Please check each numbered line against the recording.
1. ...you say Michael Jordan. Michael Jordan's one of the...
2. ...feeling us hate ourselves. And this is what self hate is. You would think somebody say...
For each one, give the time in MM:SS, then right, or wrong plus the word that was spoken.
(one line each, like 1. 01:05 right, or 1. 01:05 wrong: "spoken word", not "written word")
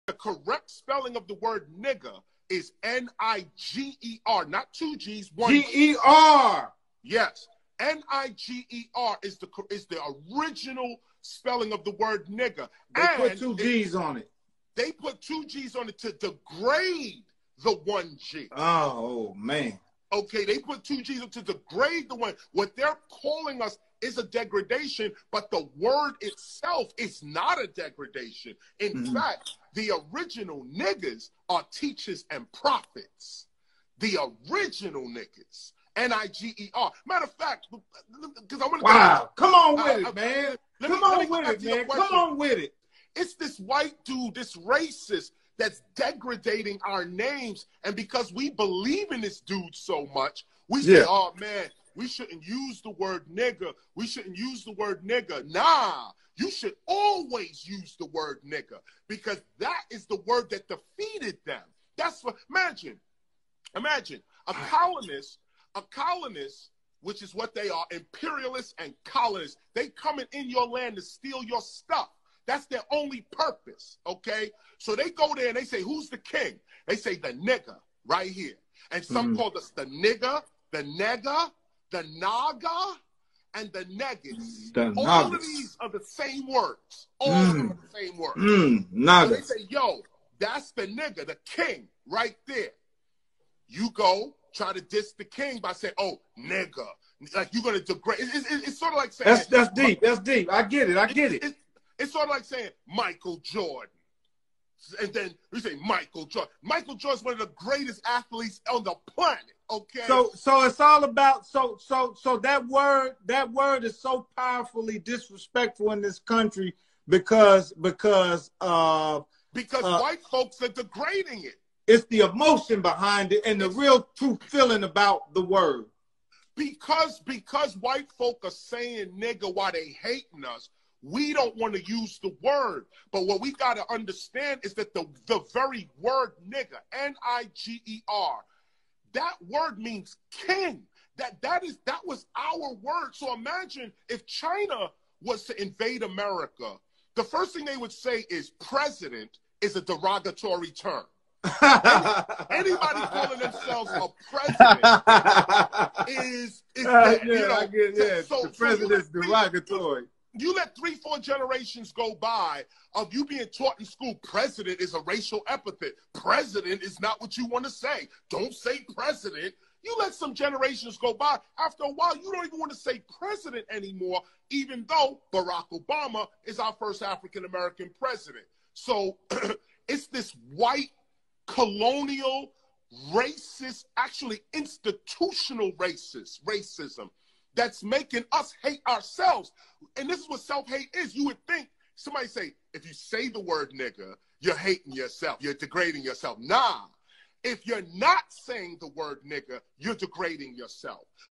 1. 01:45 right
2. 03:07 wrong: "making", not "feeling".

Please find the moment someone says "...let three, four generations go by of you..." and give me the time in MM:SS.
02:40.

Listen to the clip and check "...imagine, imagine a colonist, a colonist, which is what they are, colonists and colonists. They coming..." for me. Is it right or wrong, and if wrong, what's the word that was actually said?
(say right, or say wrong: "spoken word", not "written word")
wrong: "imperialists", not "colonists".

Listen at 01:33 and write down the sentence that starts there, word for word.
You go try to diss the king by saying, oh, nigga.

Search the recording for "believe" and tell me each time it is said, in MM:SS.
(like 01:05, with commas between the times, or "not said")
00:48.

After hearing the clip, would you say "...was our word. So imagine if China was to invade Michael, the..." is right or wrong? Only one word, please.
wrong.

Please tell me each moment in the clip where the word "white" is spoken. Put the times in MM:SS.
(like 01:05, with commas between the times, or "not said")
00:43, 01:59, 02:07, 03:00.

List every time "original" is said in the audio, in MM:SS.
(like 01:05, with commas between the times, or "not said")
00:10, 00:30, 00:34.